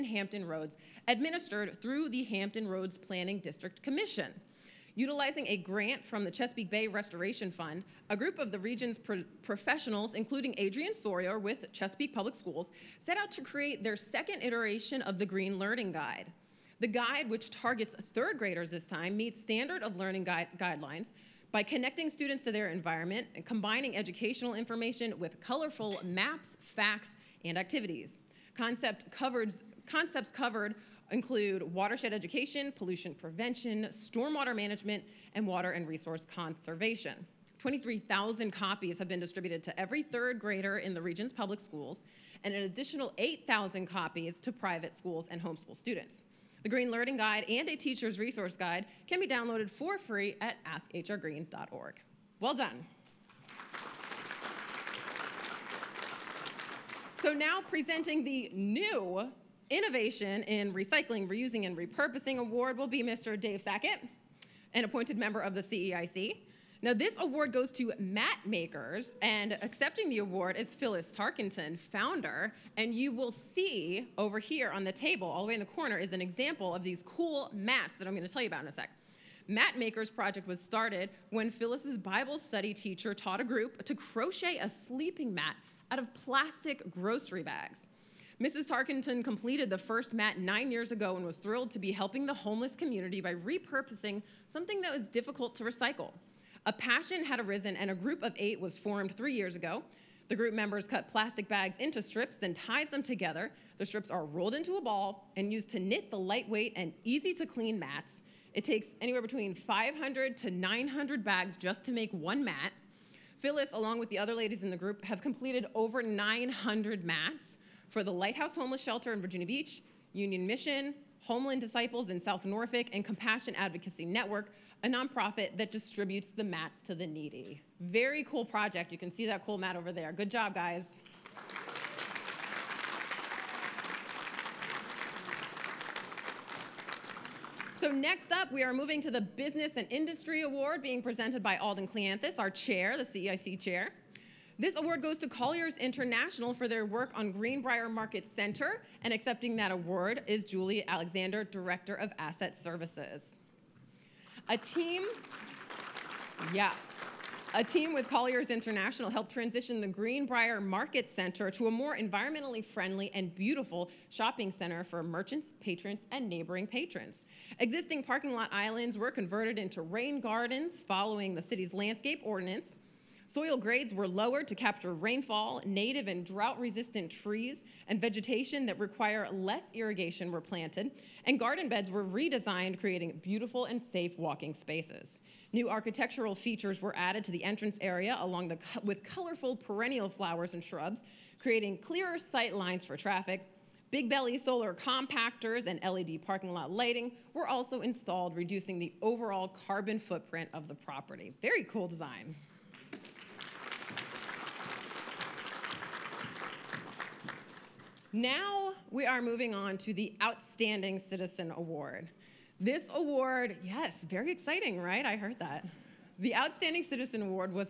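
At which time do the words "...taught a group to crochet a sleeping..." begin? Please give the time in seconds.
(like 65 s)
83 s.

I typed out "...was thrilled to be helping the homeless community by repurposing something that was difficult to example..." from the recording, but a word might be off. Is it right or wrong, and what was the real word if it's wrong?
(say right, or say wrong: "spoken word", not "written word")
wrong: "recycle", not "example".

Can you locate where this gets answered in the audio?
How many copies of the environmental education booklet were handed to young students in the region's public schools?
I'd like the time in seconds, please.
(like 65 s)
37 s.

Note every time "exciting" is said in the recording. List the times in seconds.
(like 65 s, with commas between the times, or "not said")
214 s.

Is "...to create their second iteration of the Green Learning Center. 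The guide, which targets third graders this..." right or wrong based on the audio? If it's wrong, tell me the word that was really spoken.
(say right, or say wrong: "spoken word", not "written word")
wrong: "Guide", not "Center".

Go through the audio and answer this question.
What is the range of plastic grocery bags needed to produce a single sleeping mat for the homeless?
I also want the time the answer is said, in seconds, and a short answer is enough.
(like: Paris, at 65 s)
500 to 900, at 109 s.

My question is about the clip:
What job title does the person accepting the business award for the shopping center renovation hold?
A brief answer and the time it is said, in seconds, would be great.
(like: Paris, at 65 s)
Director of Asset Services, at 151 s.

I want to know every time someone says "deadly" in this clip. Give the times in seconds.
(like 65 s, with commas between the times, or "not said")
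not said.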